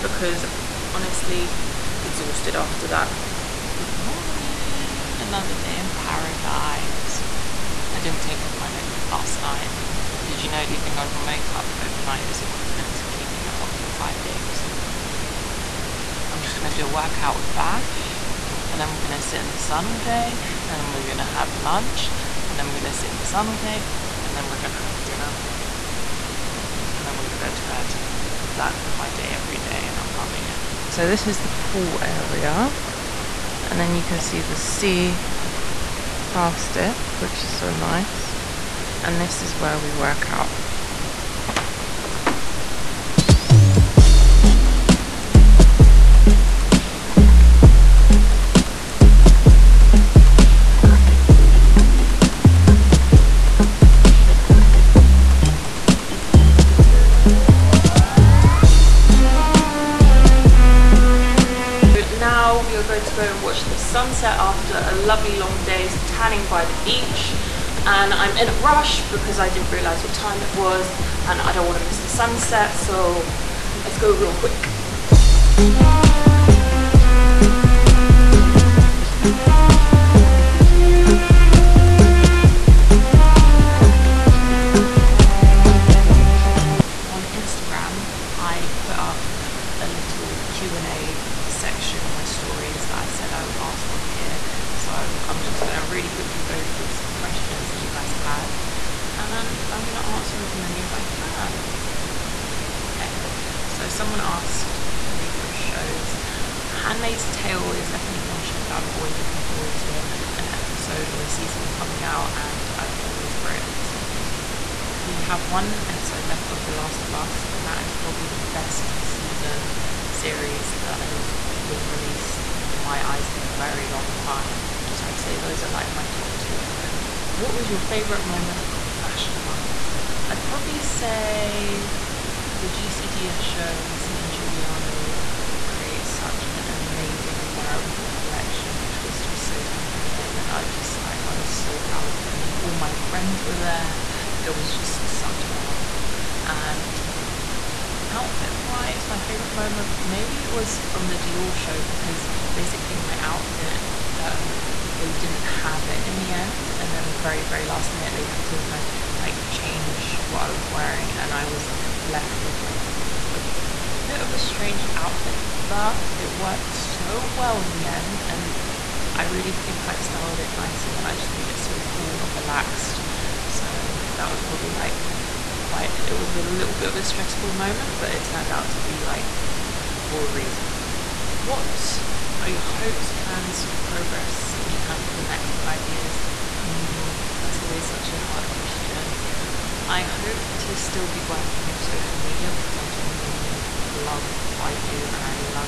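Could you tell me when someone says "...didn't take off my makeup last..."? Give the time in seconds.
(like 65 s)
8 s.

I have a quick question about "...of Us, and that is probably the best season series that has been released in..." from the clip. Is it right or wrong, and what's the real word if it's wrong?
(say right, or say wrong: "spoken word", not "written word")
right.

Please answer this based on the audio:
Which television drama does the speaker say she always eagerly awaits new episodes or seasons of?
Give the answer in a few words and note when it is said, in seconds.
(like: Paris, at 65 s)
Handmaid's Tale, at 106 s.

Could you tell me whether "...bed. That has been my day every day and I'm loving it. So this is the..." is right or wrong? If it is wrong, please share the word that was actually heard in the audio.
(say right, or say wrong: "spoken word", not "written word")
right.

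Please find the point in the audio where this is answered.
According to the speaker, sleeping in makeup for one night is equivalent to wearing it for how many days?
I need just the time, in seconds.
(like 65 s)
13 s.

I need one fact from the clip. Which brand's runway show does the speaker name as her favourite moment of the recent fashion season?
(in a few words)
GCDS.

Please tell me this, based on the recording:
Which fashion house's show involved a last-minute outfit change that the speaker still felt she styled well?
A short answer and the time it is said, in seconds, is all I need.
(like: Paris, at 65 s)
Dior, at 151 s.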